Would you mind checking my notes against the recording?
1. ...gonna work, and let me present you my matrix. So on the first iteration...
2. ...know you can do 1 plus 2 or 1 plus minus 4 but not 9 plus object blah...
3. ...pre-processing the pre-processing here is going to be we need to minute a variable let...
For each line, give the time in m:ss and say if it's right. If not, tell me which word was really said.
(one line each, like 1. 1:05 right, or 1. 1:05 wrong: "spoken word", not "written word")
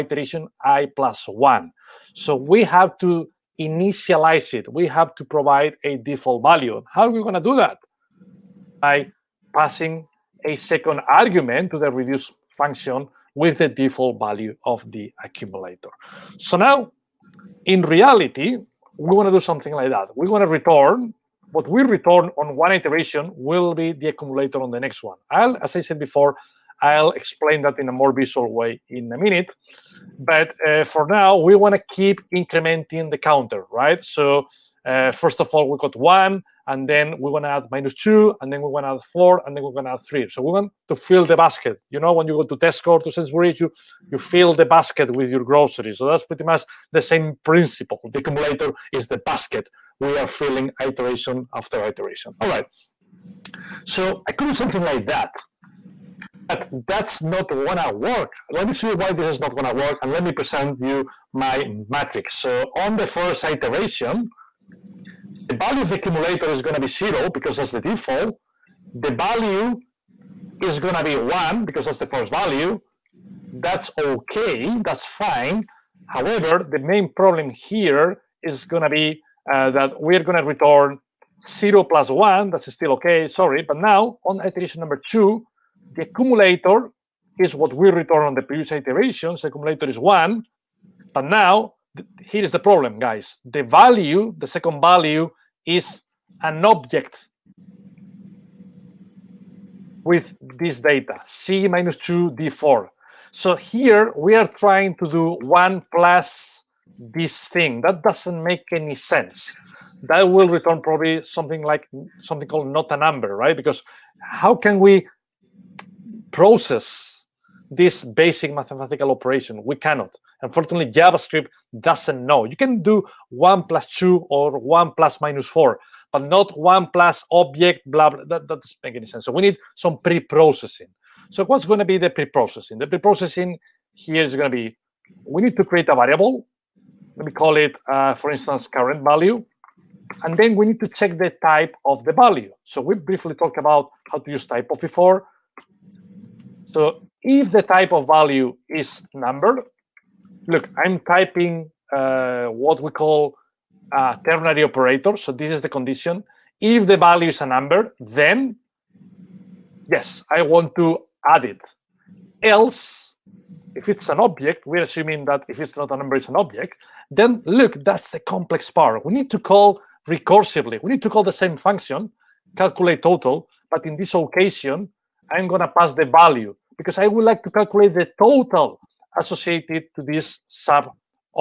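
1. 0:59 right
2. 2:02 wrong: "1", not "9"
3. 2:12 wrong: "create", not "minute".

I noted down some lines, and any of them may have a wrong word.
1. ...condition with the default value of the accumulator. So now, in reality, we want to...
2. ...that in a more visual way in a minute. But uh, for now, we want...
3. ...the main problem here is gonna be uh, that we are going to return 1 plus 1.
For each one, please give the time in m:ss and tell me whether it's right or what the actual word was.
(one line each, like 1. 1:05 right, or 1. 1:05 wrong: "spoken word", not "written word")
1. 0:12 wrong: "function", not "condition"
2. 0:27 right
3. 1:16 wrong: "0", not "1".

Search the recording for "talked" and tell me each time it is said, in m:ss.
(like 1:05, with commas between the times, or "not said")
2:23.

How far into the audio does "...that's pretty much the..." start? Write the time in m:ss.
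0:46.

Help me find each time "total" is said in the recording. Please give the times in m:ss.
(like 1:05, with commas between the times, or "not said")
2:53, 2:58.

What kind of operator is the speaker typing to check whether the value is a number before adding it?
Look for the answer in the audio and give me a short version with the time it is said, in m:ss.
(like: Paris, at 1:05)
Ternary operator, at 2:34.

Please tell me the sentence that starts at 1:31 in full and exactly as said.
But now here is the problem, guys.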